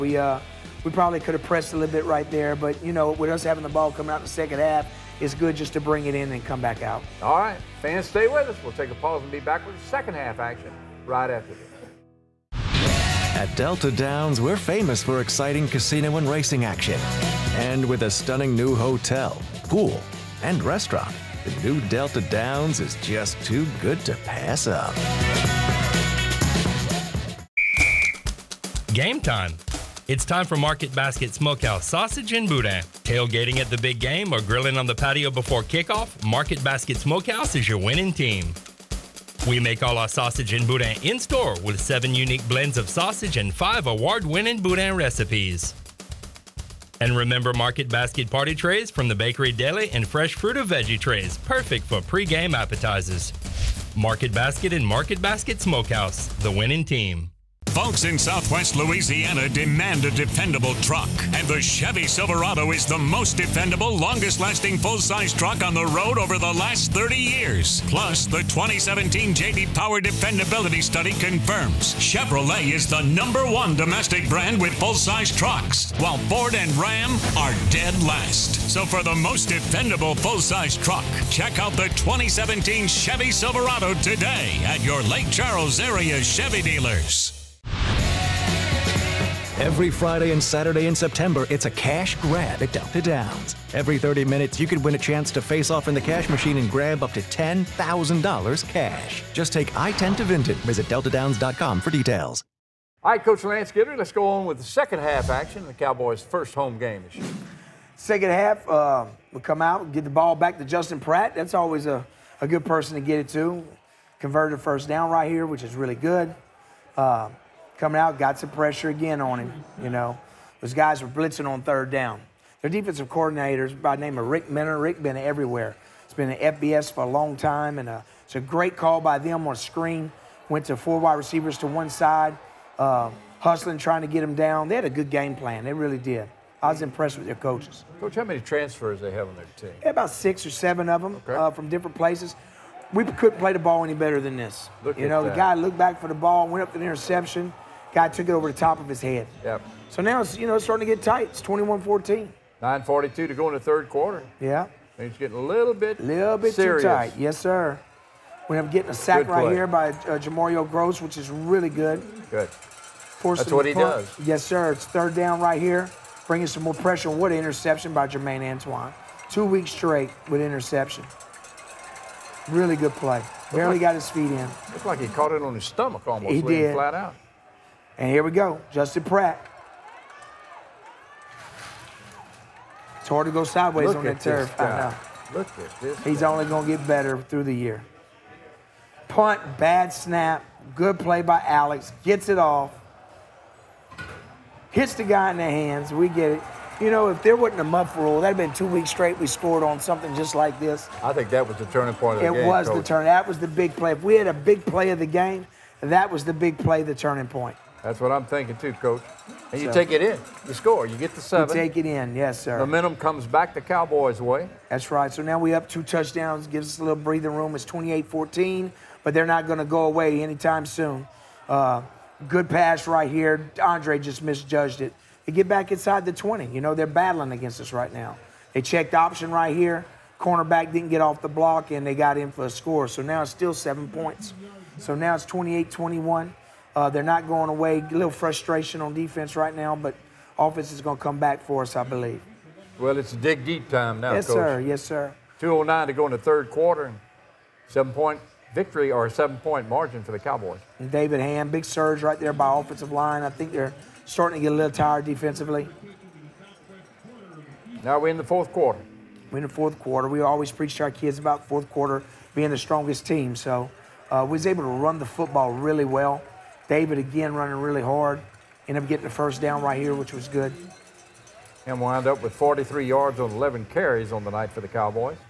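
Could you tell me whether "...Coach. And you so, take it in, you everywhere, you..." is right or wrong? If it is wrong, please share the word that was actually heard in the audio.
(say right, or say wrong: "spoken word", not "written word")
wrong: "score", not "everywhere".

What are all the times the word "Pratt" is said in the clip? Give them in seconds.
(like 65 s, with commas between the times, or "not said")
110 s, 179 s.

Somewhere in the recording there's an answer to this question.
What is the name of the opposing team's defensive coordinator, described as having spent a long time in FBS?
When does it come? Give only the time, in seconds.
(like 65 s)
124 s.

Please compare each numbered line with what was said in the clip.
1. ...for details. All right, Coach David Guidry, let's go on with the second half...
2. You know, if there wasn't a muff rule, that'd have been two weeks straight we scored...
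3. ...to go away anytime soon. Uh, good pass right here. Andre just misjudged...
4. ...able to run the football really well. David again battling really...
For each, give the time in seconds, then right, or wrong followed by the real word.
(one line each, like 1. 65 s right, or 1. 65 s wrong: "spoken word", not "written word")
1. 101 s wrong: "Lance", not "David"
2. 196 s right
3. 219 s right
4. 264 s wrong: "running", not "battling".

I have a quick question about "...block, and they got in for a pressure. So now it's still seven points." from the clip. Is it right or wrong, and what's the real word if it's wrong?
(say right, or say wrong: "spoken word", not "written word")
wrong: "score", not "pressure".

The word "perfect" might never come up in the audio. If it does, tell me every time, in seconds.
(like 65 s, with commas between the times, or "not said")
51 s.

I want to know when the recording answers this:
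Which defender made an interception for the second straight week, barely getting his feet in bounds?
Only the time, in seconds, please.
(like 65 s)
168 s.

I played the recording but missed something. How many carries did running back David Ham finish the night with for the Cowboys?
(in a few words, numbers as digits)
11.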